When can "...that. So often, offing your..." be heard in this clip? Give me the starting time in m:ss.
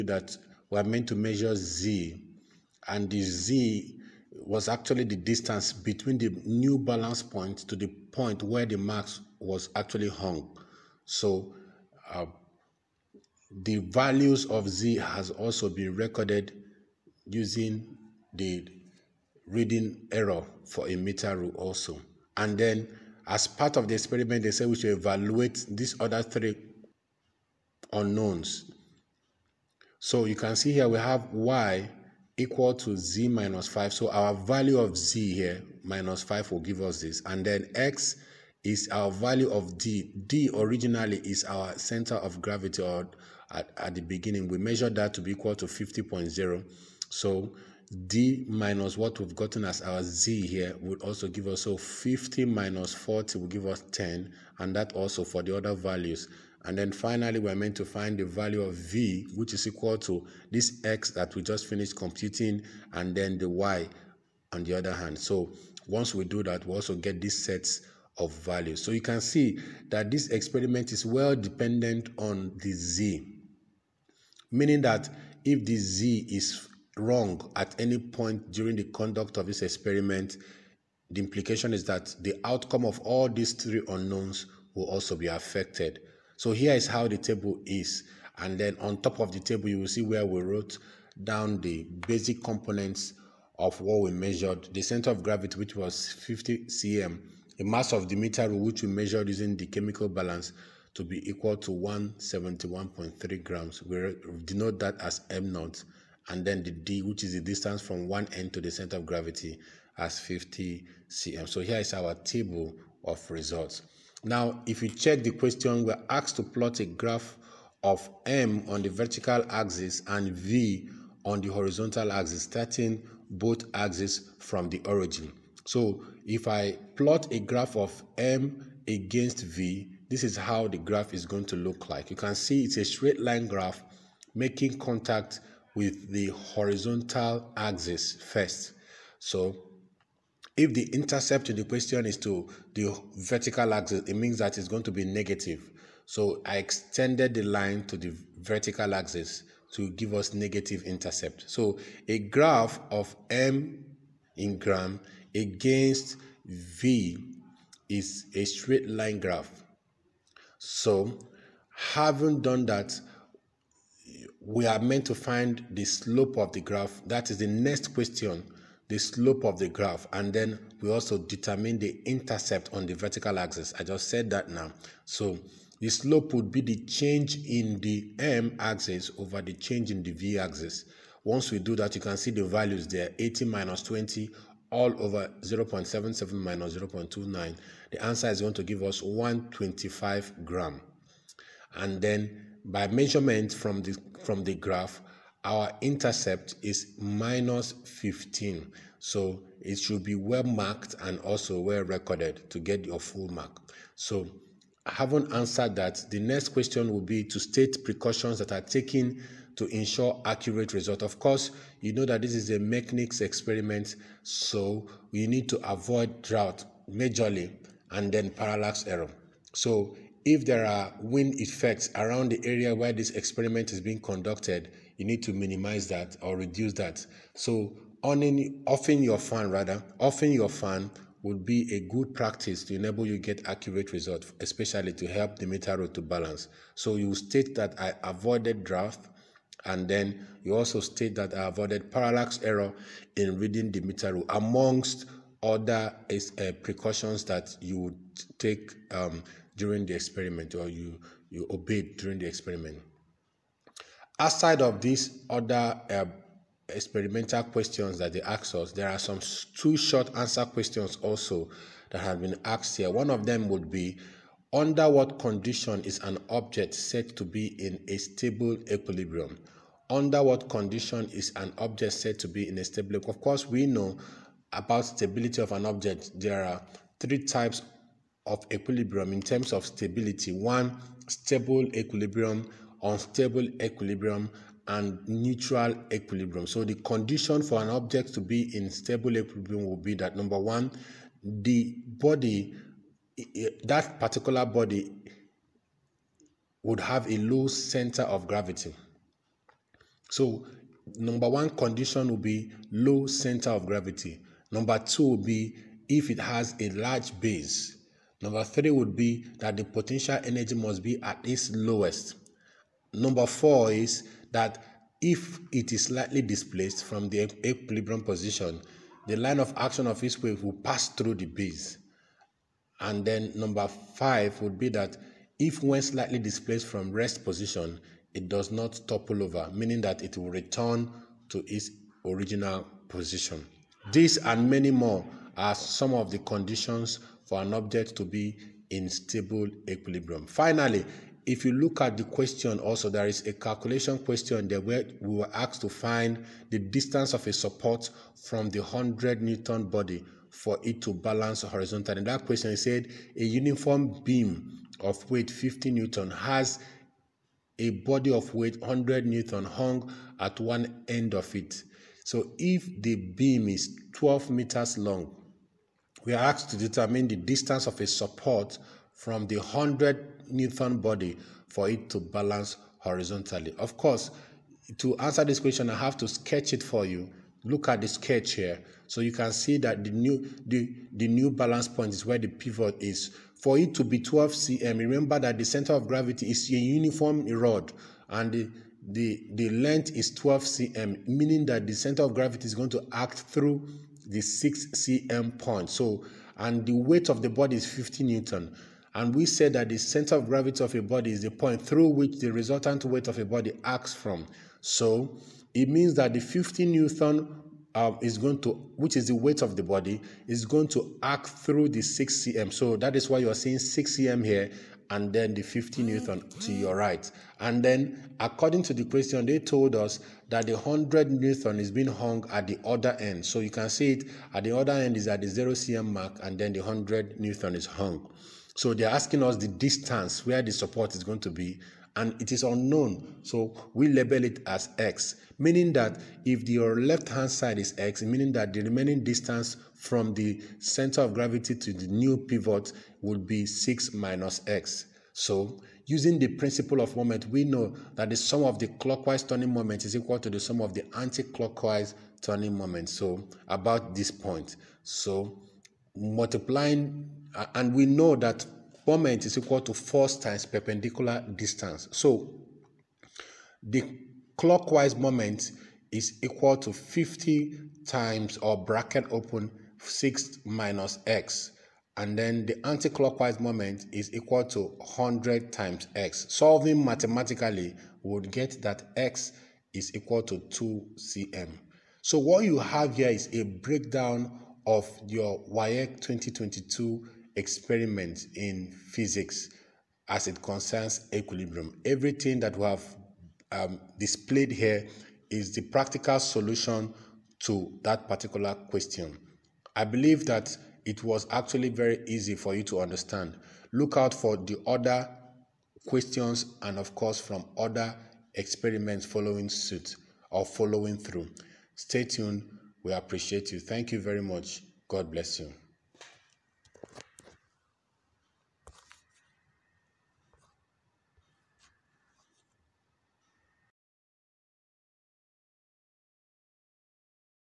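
3:46.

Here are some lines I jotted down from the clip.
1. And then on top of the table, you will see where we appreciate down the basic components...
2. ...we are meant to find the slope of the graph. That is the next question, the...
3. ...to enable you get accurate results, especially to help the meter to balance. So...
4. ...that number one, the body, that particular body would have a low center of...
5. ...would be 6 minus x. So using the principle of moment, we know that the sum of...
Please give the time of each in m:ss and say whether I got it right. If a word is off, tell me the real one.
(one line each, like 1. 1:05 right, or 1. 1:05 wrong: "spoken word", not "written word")
1. 1:28 wrong: "wrote", not "appreciate"
2. 2:44 right
3. 3:52 right
4. 4:49 right
5. 7:23 right.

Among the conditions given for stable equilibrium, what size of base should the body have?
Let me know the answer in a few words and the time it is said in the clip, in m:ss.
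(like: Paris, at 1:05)
Large, at 5:06.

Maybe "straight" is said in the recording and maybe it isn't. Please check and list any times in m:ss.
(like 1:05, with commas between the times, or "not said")
2:12, 2:38.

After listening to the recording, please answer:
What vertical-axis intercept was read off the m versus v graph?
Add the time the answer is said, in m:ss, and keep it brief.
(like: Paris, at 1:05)
-15, at 3:16.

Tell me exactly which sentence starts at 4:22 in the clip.
One of them would be under what condition is an object said to be in a stable equilibrium?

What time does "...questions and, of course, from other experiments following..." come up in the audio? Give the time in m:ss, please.
8:25.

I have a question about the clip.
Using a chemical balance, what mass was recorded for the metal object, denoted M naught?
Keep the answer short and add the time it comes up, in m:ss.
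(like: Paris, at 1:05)
171.3 grams, at 1:41.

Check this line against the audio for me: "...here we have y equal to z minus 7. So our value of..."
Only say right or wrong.
wrong.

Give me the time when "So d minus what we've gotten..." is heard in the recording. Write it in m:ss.
0:47.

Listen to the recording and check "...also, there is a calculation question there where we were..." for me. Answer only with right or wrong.
right.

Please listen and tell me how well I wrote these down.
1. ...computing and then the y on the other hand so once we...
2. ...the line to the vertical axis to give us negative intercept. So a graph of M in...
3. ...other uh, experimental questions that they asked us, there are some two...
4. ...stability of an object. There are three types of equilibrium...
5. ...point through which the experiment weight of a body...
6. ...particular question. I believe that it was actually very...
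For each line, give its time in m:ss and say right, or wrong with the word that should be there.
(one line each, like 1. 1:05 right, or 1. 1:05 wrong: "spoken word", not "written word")
1. 1:01 right
2. 2:27 right
3. 4:15 right
4. 4:34 right
5. 6:41 wrong: "resultant", not "experiment"
6. 8:18 right.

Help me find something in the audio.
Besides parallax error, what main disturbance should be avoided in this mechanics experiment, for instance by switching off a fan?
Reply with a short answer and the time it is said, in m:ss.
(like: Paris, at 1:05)
Draft, at 3:36.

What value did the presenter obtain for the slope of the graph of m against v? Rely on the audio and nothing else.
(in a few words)
125 gram.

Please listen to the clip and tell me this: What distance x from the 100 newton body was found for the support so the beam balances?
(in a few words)
2 cm.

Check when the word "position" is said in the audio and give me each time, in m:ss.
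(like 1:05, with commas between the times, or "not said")
5:18, 5:27, 5:32.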